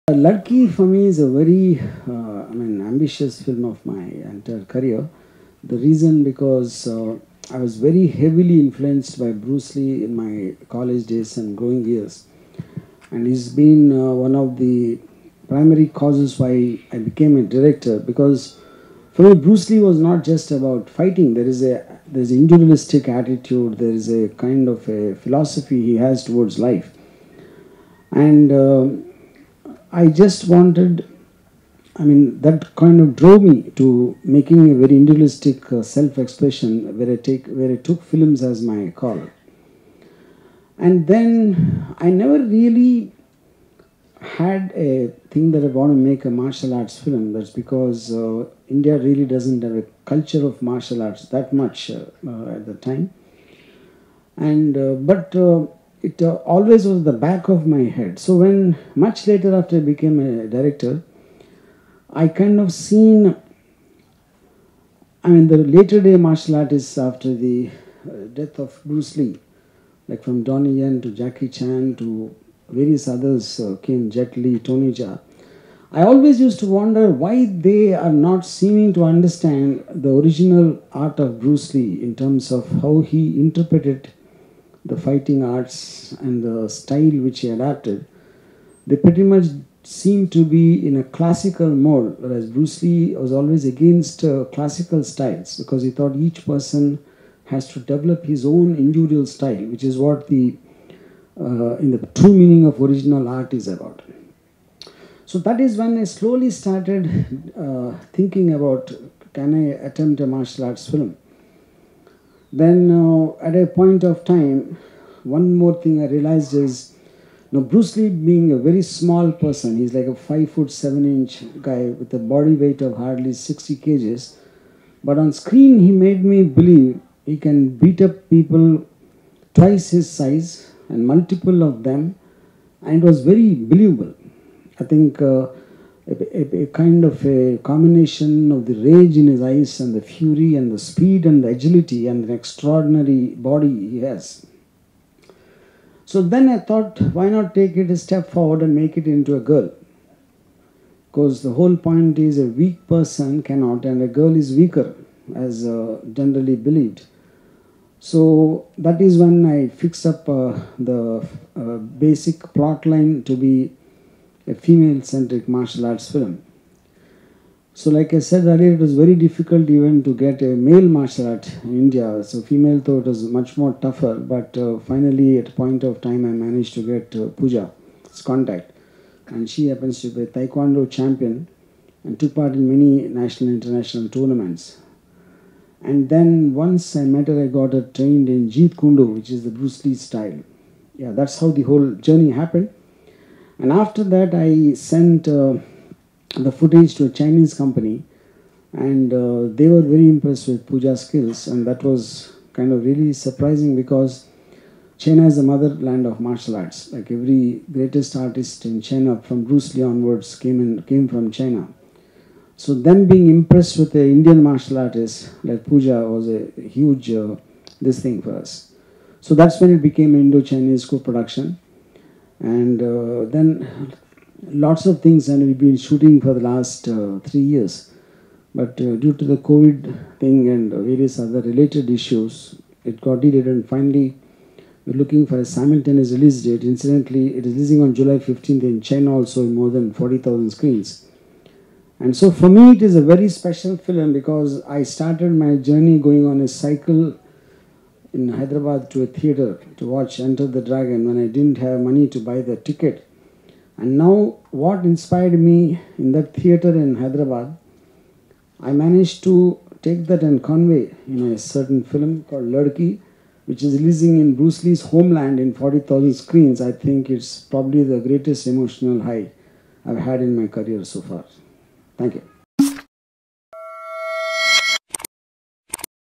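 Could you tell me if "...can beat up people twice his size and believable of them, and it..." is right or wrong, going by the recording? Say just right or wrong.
wrong.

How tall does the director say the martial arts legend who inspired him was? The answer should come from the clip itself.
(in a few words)
5 foot 7 inches.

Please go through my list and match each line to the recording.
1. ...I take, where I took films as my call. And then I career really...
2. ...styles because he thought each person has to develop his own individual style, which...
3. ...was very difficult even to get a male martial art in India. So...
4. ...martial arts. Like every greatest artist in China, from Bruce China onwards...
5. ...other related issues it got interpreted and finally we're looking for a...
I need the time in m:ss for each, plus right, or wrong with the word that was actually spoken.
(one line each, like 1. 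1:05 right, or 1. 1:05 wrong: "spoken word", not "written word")
1. 0:37 wrong: "never", not "career"
2. 1:35 right
3. 2:48 right
4. 3:26 wrong: "Lee", not "China"
5. 3:51 wrong: "delayed", not "interpreted".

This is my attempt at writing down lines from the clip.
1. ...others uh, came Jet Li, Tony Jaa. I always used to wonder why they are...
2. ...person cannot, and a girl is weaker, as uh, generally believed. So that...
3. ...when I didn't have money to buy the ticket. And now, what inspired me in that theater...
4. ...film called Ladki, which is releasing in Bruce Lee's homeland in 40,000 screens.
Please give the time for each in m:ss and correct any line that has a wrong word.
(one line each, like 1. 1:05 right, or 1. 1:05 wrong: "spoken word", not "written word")
1. 1:13 right
2. 2:32 right
3. 4:11 right
4. 4:21 right.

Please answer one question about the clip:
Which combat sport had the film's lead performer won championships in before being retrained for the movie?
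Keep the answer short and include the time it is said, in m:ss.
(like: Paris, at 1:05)
Taekwondo, at 3:00.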